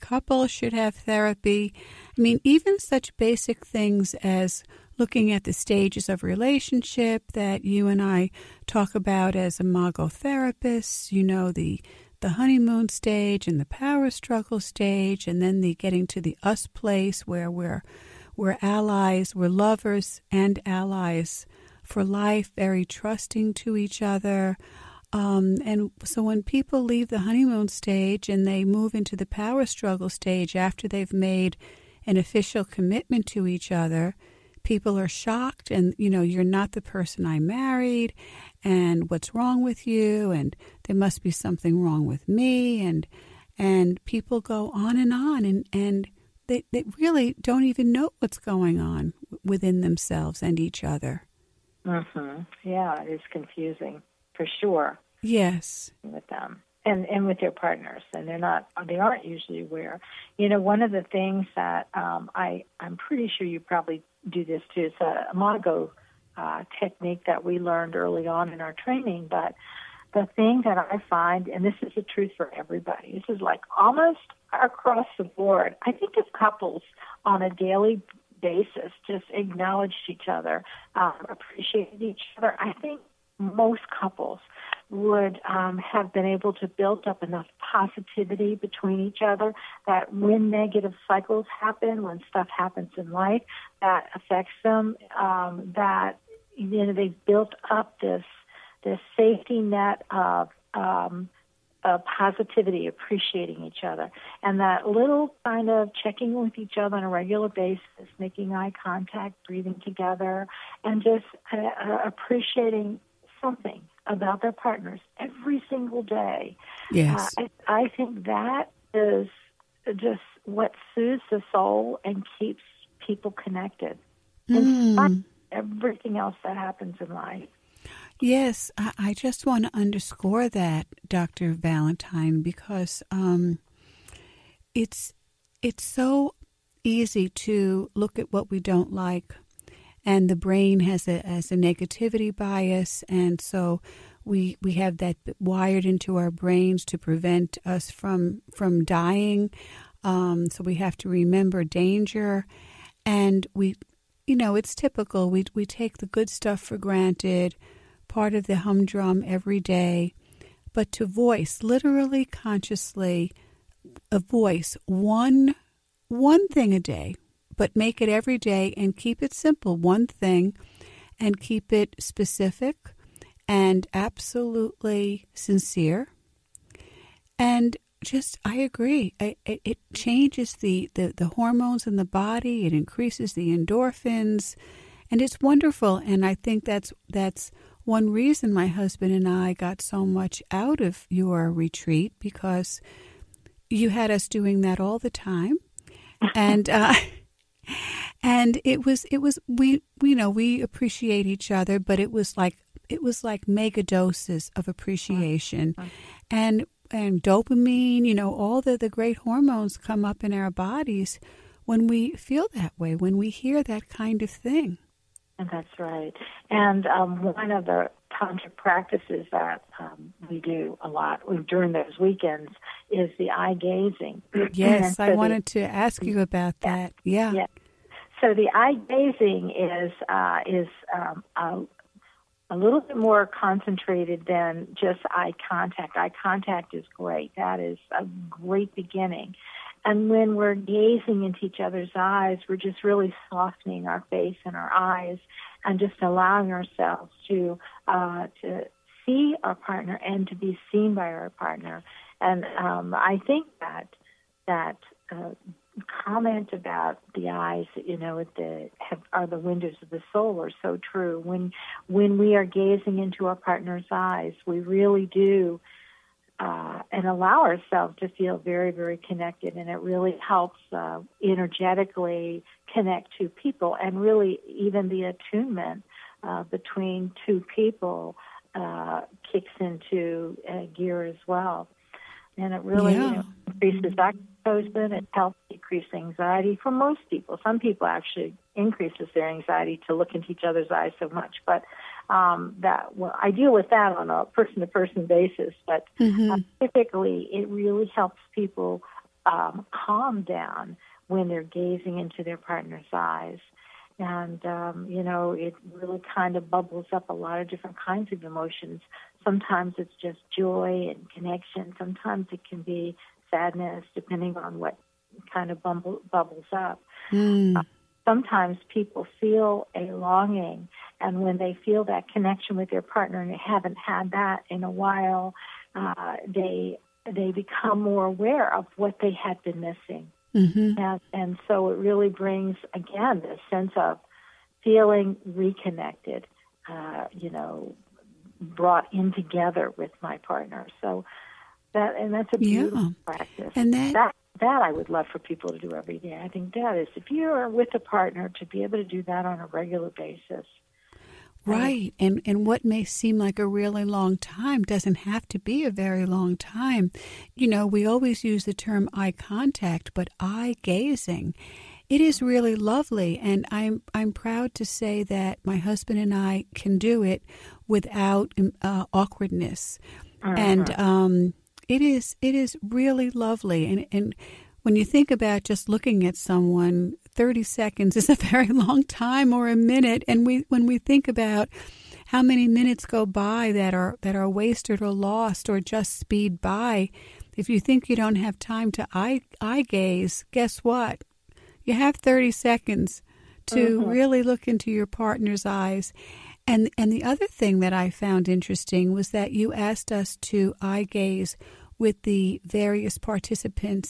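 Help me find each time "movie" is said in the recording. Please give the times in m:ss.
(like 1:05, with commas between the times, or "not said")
not said.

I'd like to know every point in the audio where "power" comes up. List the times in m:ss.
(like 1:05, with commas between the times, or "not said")
0:13, 0:29.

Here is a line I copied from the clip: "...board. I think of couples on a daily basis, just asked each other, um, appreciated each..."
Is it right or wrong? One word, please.
wrong.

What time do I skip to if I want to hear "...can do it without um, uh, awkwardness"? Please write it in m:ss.
6:06.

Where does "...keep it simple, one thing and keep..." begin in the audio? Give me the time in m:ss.
2:48.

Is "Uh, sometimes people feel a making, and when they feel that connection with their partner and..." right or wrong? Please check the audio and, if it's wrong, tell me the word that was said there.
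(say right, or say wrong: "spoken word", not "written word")
wrong: "longing", not "making".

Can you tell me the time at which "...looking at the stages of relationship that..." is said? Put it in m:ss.
0:04.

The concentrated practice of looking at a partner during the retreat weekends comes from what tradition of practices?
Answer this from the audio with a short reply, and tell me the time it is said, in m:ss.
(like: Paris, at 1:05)
Tantra, at 3:38.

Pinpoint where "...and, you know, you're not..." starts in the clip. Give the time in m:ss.
0:35.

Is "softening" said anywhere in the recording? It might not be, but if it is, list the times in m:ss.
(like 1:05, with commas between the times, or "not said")
4:03.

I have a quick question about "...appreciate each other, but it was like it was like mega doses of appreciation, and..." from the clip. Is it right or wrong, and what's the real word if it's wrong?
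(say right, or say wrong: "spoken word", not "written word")
right.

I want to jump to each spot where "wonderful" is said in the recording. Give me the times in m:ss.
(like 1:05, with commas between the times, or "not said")
3:05.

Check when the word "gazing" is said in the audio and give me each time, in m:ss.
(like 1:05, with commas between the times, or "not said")
3:43, 3:48, 4:00, 4:22, 5:01, 6:00.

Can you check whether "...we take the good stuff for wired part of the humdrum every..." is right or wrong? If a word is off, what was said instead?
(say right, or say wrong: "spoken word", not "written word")
wrong: "granted", not "wired".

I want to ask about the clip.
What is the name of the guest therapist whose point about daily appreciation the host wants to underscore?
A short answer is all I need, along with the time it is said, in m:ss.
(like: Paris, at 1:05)
Dr. Valentine, at 2:11.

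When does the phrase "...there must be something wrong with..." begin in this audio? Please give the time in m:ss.
0:40.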